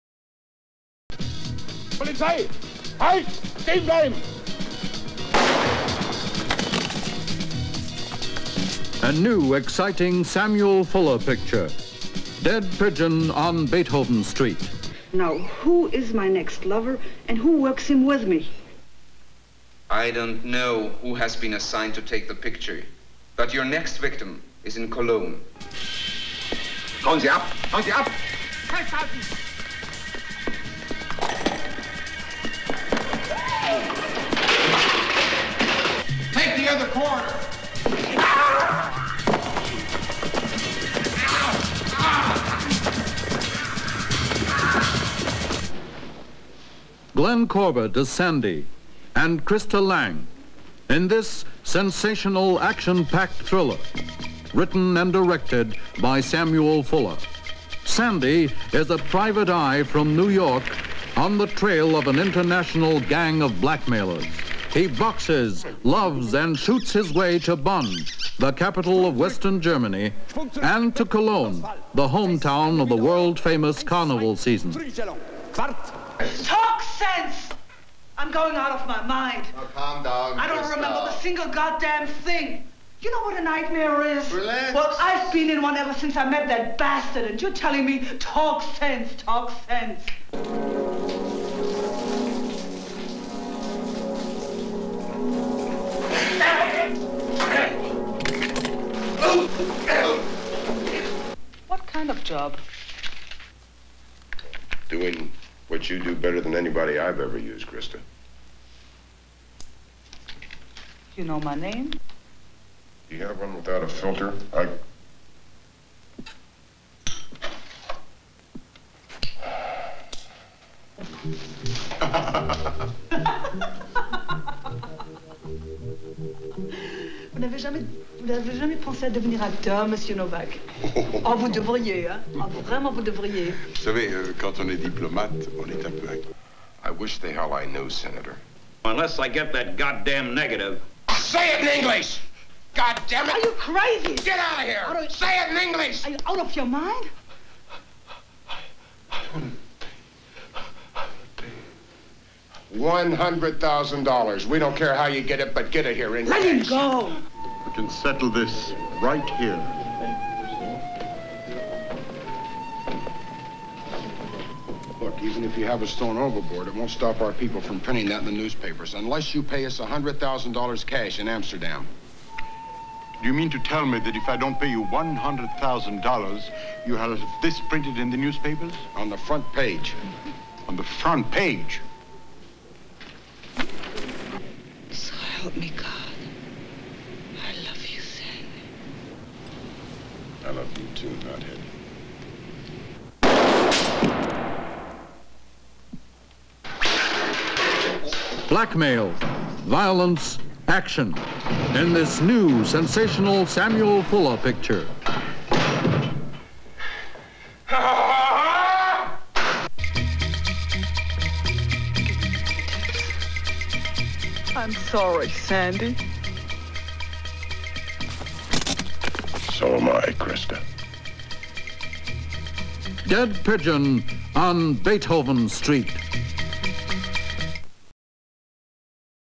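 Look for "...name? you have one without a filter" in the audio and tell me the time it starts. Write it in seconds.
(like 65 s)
111 s.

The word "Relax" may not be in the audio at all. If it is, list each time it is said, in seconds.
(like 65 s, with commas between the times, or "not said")
84 s.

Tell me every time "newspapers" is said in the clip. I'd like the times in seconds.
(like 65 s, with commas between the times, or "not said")
168 s, 178 s.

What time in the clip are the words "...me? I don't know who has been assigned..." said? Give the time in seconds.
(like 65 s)
18 s.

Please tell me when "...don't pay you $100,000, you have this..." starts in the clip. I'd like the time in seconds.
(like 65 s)
174 s.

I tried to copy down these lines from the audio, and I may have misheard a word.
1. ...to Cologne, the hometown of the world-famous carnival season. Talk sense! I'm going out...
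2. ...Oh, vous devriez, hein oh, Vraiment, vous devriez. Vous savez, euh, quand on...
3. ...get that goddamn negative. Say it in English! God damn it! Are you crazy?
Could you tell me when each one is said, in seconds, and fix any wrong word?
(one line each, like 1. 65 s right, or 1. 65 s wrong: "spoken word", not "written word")
1. 70 s right
2. 131 s right
3. 139 s right.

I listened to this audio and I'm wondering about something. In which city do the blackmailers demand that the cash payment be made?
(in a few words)
Amsterdam.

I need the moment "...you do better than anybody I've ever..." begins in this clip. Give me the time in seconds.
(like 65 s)
105 s.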